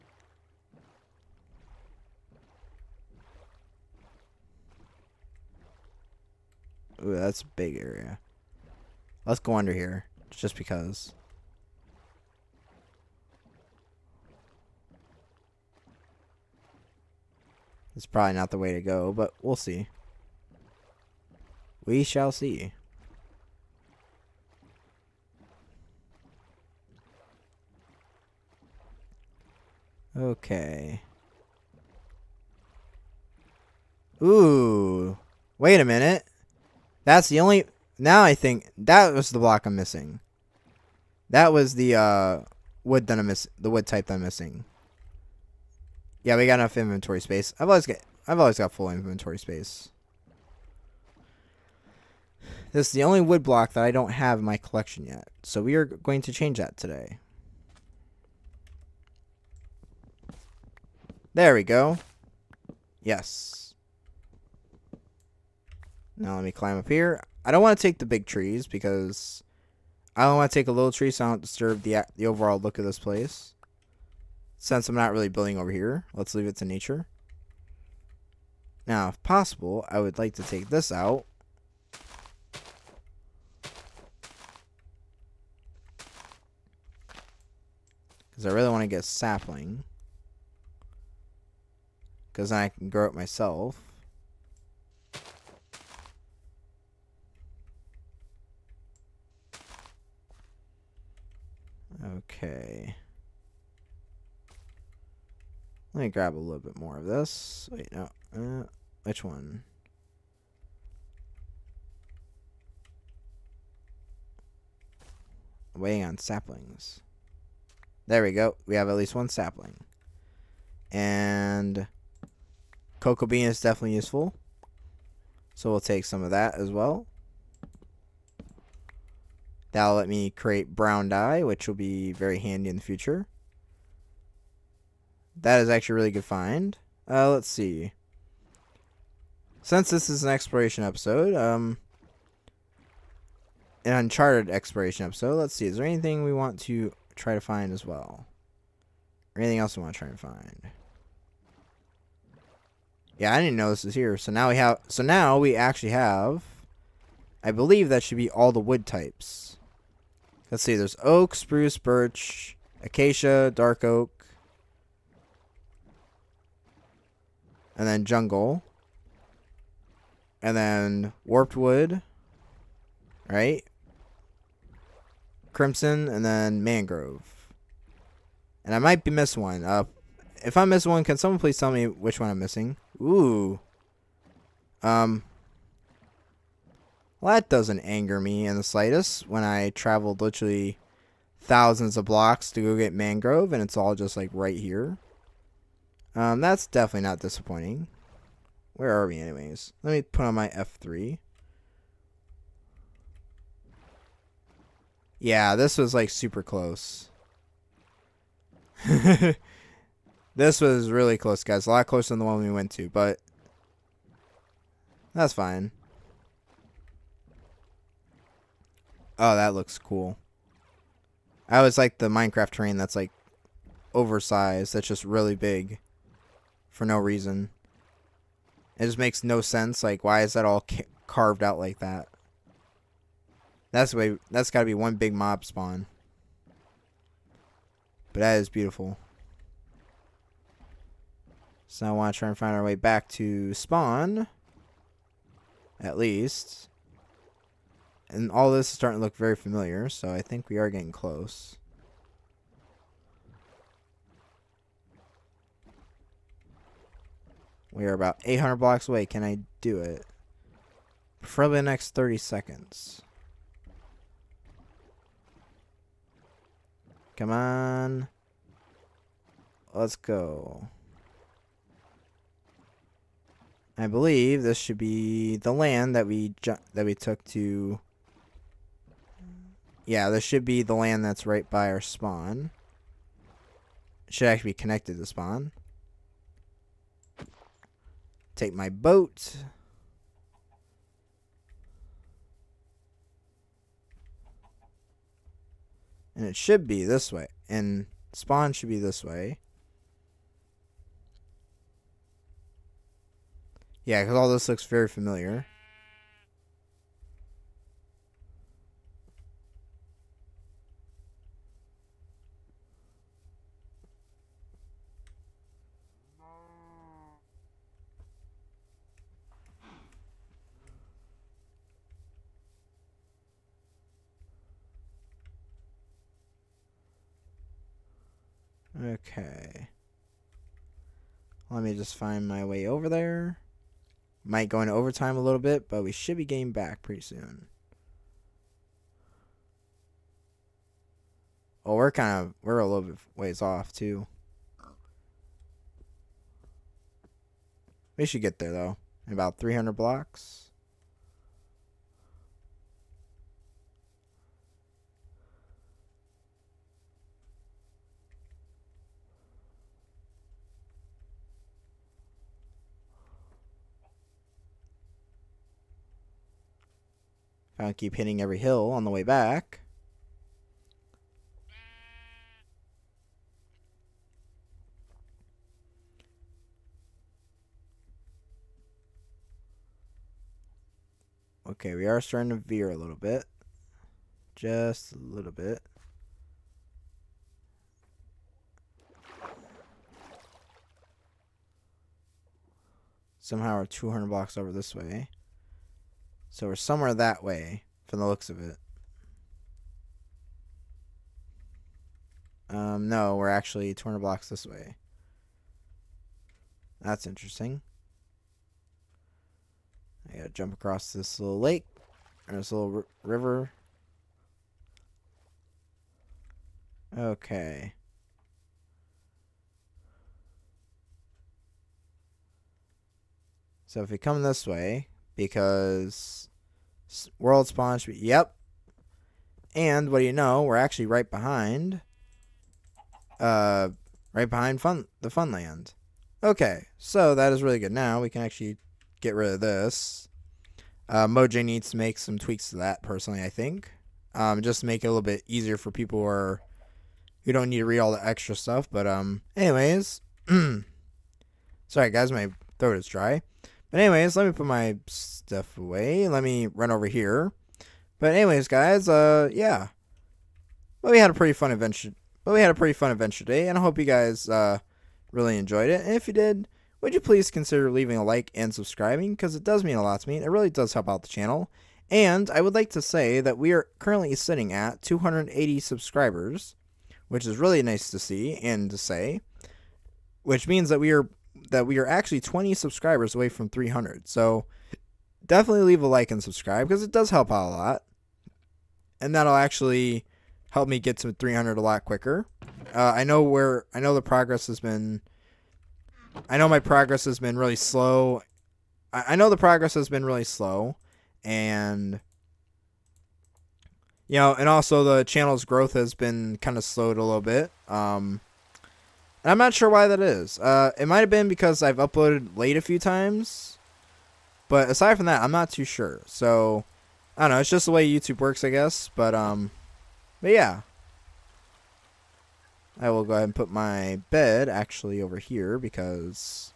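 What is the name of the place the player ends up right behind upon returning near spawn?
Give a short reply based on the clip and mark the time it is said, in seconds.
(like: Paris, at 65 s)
Funland, at 434 s.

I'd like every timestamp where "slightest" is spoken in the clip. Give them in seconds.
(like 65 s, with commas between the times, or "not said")
188 s.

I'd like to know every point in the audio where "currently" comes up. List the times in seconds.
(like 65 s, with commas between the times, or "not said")
473 s.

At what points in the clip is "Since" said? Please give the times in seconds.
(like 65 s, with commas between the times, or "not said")
74 s, 139 s.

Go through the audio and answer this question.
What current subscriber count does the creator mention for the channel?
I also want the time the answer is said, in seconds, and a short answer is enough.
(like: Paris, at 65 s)
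280, at 474 s.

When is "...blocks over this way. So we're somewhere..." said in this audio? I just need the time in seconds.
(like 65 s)
394 s.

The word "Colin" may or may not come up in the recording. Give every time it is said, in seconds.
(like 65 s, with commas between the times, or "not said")
not said.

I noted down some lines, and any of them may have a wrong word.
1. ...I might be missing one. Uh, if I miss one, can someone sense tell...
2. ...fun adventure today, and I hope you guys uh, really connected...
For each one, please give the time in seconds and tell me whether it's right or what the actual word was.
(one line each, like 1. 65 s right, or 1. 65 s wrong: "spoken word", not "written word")
1. 178 s wrong: "please", not "sense"
2. 462 s wrong: "enjoyed", not "connected".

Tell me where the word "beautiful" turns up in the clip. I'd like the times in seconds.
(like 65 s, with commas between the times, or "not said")
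238 s.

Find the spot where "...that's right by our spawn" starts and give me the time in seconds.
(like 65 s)
281 s.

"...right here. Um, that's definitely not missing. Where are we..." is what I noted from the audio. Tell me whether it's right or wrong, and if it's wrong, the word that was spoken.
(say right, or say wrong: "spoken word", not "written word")
wrong: "disappointing", not "missing".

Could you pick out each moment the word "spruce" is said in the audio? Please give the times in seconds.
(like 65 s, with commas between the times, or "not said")
161 s.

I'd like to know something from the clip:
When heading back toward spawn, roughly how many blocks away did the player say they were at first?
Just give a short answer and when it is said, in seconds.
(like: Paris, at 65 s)
800, at 258 s.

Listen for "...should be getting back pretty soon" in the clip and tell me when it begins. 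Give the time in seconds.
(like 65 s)
335 s.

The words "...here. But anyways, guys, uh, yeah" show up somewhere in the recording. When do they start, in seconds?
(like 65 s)
456 s.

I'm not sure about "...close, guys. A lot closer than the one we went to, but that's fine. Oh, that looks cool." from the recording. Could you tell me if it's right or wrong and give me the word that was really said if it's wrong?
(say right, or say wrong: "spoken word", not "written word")
right.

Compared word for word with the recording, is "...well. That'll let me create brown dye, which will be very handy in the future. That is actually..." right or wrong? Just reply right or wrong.
right.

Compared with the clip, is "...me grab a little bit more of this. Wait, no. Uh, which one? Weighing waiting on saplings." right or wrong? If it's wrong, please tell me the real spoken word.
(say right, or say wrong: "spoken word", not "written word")
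right.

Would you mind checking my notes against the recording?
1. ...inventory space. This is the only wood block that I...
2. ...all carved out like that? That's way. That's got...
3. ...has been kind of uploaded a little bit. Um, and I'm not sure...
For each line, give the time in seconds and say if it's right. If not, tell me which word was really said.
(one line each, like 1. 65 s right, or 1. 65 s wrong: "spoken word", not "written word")
1. 48 s right
2. 230 s right
3. 505 s wrong: "slowed", not "uploaded".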